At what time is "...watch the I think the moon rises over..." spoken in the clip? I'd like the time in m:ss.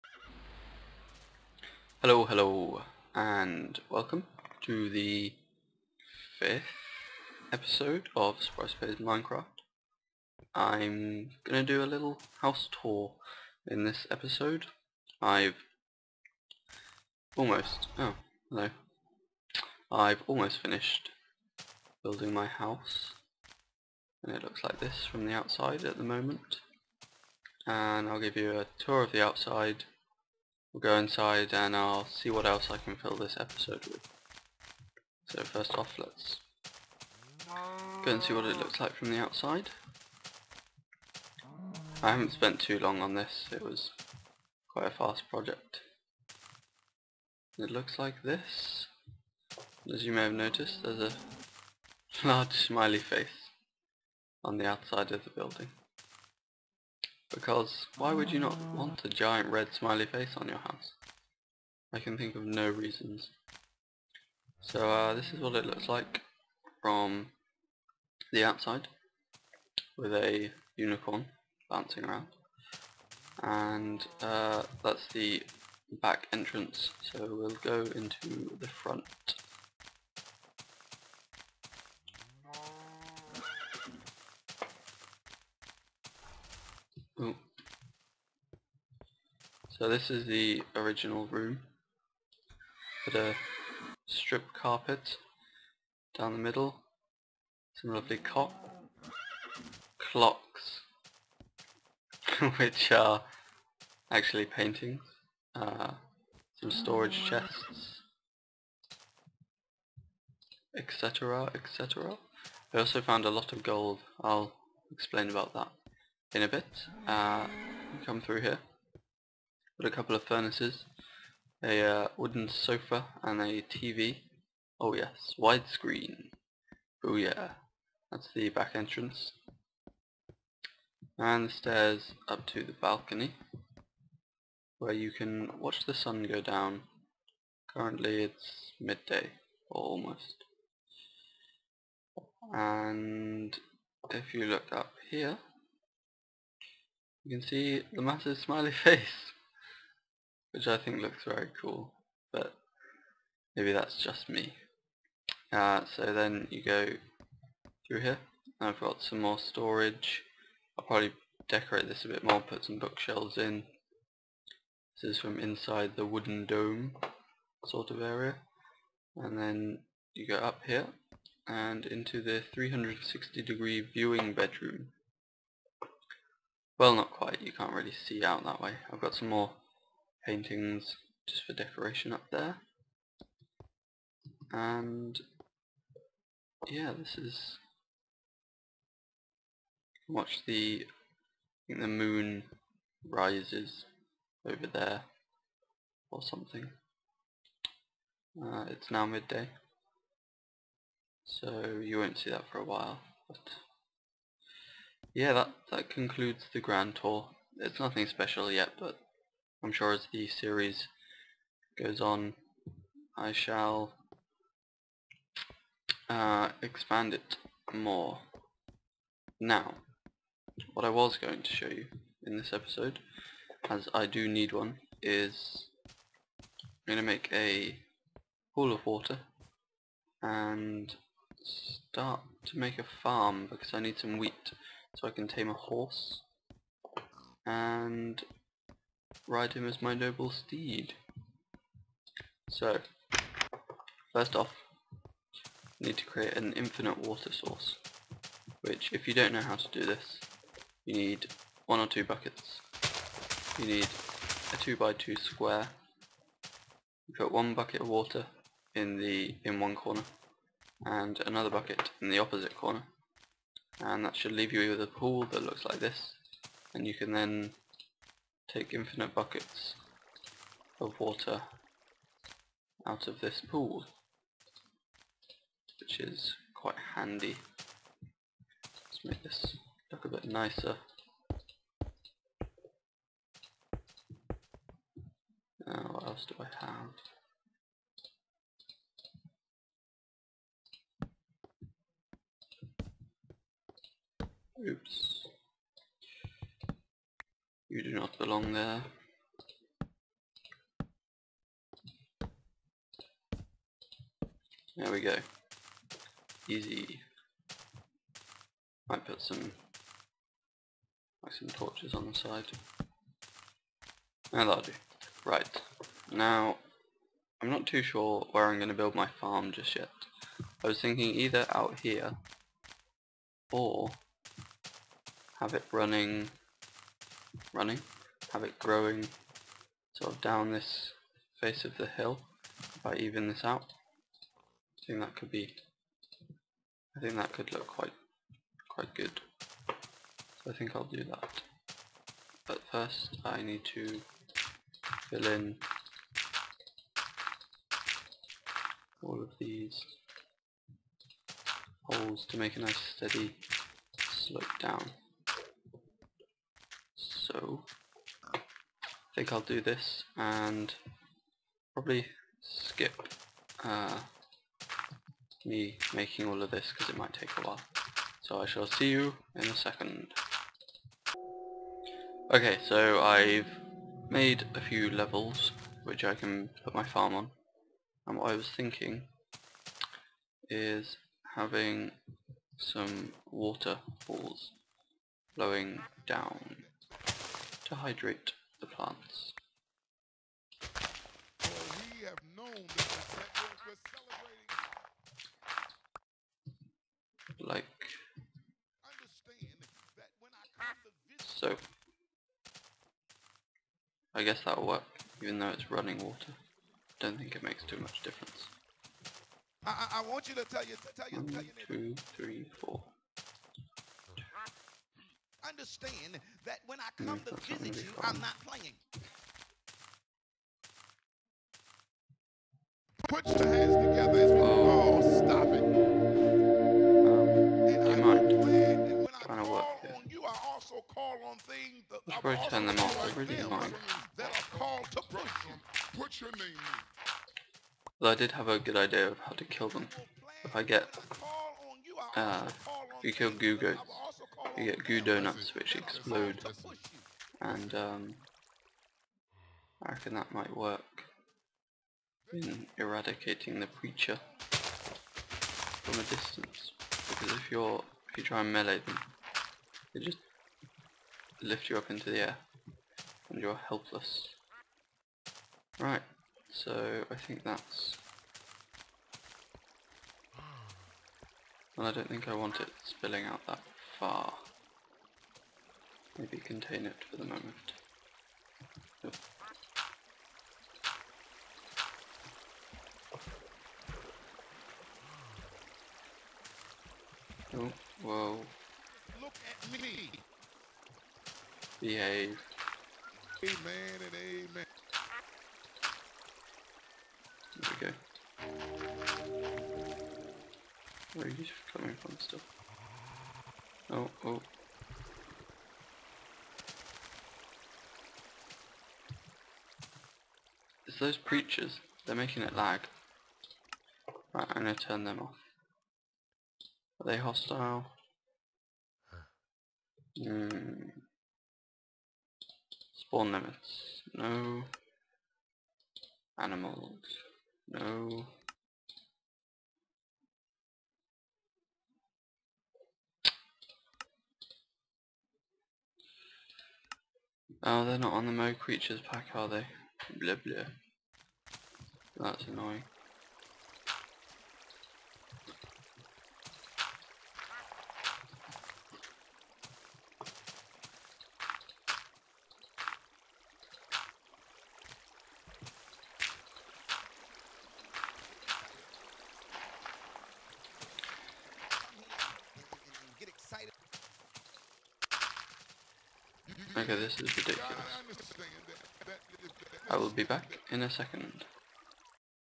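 3:10.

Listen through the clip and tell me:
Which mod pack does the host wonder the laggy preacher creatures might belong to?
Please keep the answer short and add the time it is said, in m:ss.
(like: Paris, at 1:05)
Mo Creatures, at 8:58.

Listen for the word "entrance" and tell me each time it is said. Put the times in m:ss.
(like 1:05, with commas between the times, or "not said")
1:16, 2:08.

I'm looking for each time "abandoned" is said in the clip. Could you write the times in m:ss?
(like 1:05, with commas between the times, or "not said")
not said.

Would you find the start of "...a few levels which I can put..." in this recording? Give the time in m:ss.
6:14.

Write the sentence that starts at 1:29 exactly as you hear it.
So this is the original room.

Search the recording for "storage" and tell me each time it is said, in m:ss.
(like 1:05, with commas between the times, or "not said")
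1:46, 2:39.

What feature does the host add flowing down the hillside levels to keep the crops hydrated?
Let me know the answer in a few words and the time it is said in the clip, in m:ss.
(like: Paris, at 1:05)
Waterfalls, at 6:23.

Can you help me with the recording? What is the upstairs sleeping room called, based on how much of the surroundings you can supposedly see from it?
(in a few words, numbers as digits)
360 degree viewing bedroom.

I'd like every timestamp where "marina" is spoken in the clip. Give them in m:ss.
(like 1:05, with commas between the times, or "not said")
not said.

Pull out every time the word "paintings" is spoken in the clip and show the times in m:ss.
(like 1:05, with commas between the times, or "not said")
1:44, 3:00.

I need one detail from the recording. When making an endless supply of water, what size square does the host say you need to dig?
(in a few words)
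2 by 2.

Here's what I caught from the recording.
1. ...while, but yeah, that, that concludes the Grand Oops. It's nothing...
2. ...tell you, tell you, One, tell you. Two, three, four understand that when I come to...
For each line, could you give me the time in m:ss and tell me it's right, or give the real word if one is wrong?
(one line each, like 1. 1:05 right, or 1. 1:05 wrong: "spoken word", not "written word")
1. 3:22 wrong: "Tour", not "Oops"
2. 6:50 right.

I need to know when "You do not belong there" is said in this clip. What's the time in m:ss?
4:57.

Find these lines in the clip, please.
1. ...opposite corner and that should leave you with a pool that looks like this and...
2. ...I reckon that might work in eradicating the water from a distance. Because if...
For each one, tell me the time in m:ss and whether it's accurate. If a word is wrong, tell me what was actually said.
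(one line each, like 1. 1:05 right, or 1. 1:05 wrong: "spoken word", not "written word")
1. 4:22 right
2. 7:29 wrong: "preacher", not "water".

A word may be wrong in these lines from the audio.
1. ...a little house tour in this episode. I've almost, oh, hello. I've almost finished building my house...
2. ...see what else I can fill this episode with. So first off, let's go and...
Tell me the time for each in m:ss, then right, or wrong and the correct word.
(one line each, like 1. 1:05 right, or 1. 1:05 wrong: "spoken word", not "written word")
1. 0:11 right
2. 0:32 right.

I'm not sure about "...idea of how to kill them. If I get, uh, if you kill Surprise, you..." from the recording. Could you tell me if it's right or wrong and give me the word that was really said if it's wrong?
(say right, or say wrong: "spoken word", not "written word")
wrong: "Gugu", not "Surprise".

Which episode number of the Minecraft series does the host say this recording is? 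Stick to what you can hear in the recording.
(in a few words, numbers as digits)
5th.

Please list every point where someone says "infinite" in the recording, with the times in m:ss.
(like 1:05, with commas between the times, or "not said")
4:06, 4:28.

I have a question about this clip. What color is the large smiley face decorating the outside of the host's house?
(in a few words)
Red.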